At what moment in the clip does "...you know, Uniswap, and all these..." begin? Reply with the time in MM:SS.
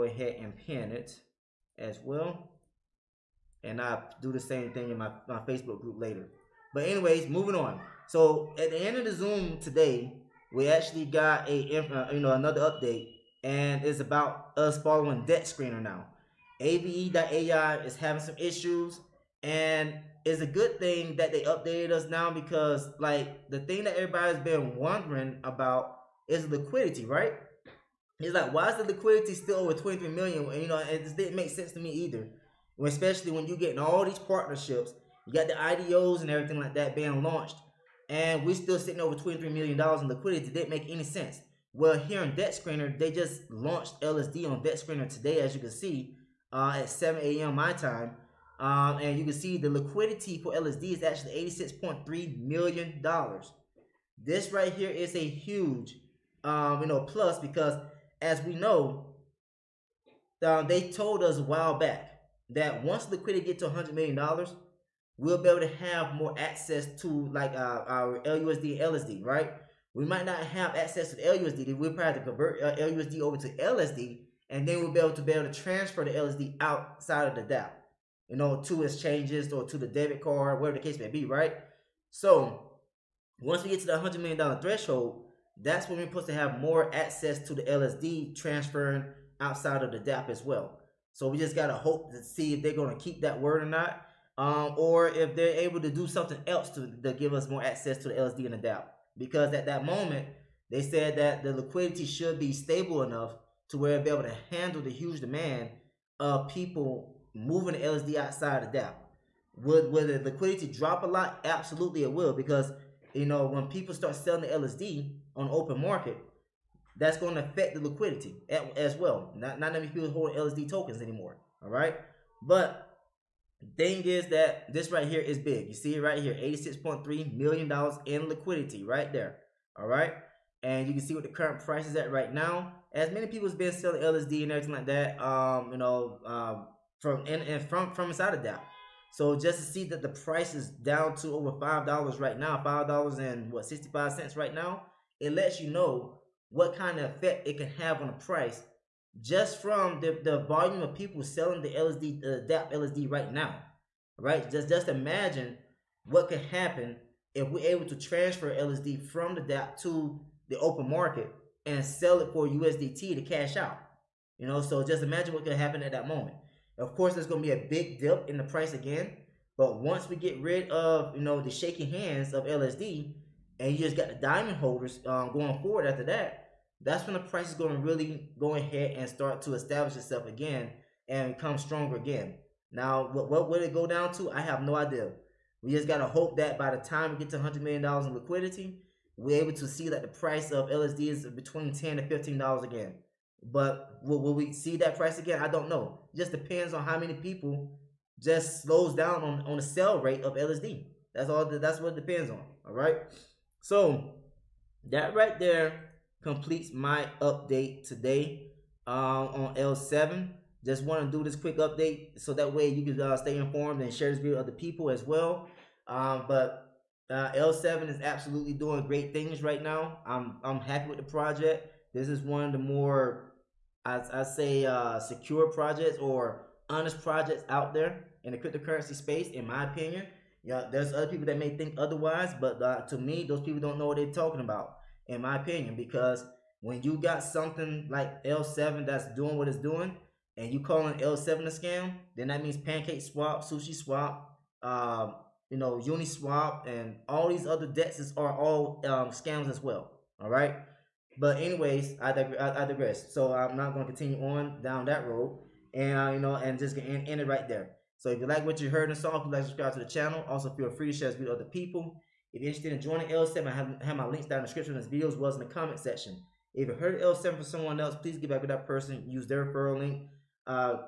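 04:05.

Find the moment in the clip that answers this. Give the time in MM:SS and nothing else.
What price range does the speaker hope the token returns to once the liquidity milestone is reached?
03:11.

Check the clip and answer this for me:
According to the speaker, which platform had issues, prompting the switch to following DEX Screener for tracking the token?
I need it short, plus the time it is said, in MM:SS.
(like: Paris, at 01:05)
AVE.ai, at 00:16.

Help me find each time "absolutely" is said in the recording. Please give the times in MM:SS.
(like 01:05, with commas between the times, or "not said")
01:51, 03:38.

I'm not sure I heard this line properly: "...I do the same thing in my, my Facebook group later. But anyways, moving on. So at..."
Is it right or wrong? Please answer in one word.
right.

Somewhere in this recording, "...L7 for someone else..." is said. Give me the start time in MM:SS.
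04:27.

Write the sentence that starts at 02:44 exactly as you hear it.
You know, so just imagine what could happen at that moment.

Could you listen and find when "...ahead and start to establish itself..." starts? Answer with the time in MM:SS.
02:58.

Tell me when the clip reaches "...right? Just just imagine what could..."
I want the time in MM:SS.
02:34.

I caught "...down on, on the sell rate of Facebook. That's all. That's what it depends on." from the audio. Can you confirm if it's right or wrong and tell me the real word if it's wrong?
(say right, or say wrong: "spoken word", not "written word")
wrong: "LSD", not "Facebook".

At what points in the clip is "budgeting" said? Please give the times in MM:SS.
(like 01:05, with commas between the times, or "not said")
not said.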